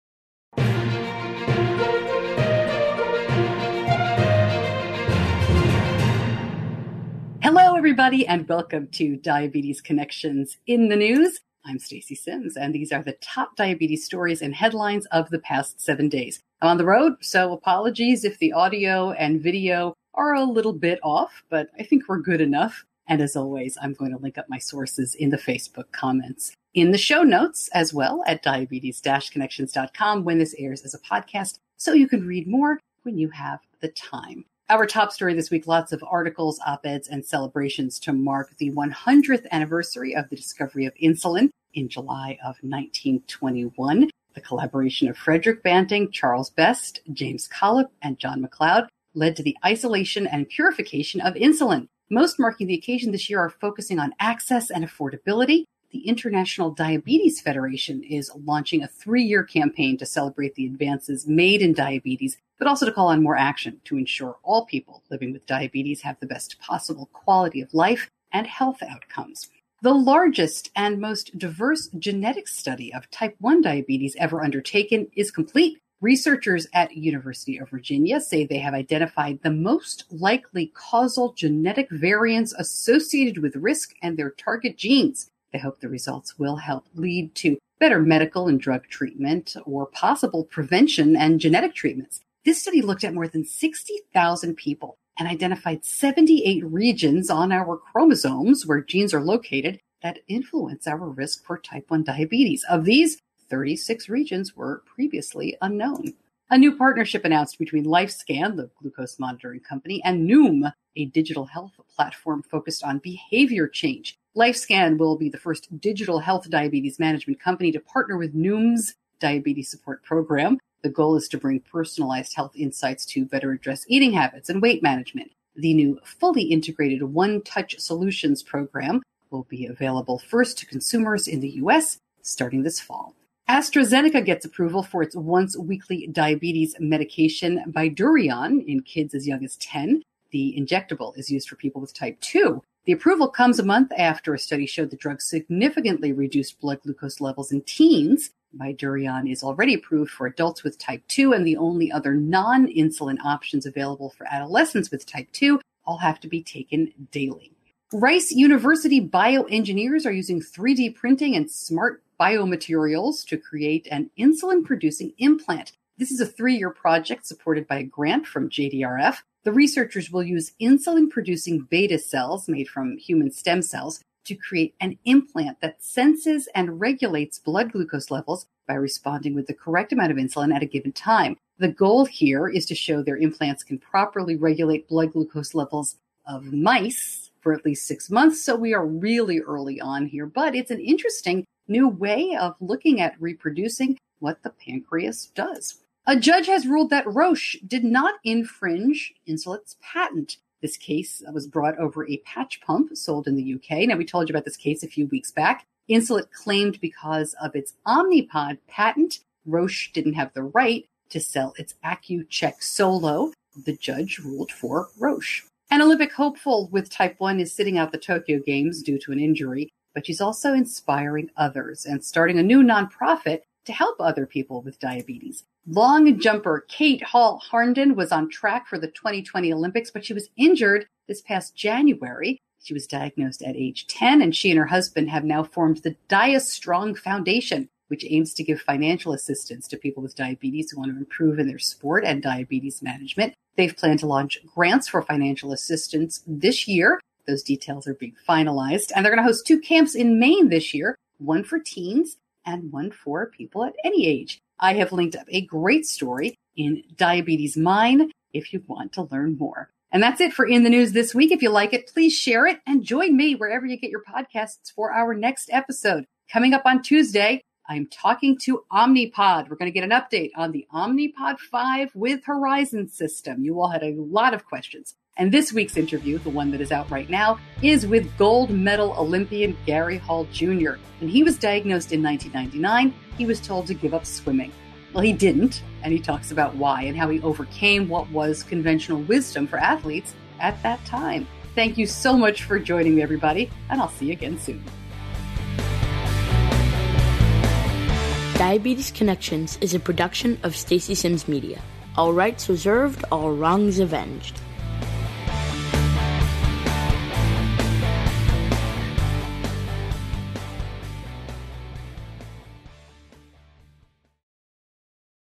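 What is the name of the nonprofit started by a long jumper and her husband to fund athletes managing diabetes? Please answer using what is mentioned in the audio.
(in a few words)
DiaStrong Foundation.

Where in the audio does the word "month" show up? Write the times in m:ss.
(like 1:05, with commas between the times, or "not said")
2:23, 3:08.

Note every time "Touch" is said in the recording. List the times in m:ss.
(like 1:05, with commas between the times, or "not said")
2:07.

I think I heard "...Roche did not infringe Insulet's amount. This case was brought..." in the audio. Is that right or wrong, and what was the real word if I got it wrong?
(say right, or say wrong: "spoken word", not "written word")
wrong: "patent", not "amount".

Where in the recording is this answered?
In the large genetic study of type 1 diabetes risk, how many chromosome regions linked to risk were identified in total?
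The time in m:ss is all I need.
1:35.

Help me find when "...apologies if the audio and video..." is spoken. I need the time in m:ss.
0:17.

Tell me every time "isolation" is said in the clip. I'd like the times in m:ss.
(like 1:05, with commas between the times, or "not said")
0:49.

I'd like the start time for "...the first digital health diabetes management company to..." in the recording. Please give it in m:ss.
1:55.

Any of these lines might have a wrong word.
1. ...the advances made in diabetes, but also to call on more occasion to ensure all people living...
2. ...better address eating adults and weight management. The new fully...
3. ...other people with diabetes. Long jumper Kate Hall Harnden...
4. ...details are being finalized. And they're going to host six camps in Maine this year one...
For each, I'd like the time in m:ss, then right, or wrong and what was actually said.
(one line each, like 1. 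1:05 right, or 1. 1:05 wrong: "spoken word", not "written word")
1. 1:00 wrong: "action", not "occasion"
2. 2:03 wrong: "habits", not "adults"
3. 3:43 right
4. 4:07 wrong: "two", not "six".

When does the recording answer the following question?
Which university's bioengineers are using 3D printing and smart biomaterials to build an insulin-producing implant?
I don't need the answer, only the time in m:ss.
2:37.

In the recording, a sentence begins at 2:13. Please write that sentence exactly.
AstraZeneca gets approval for its once-weekly diabetes medication Bydureon in kids as young as 10.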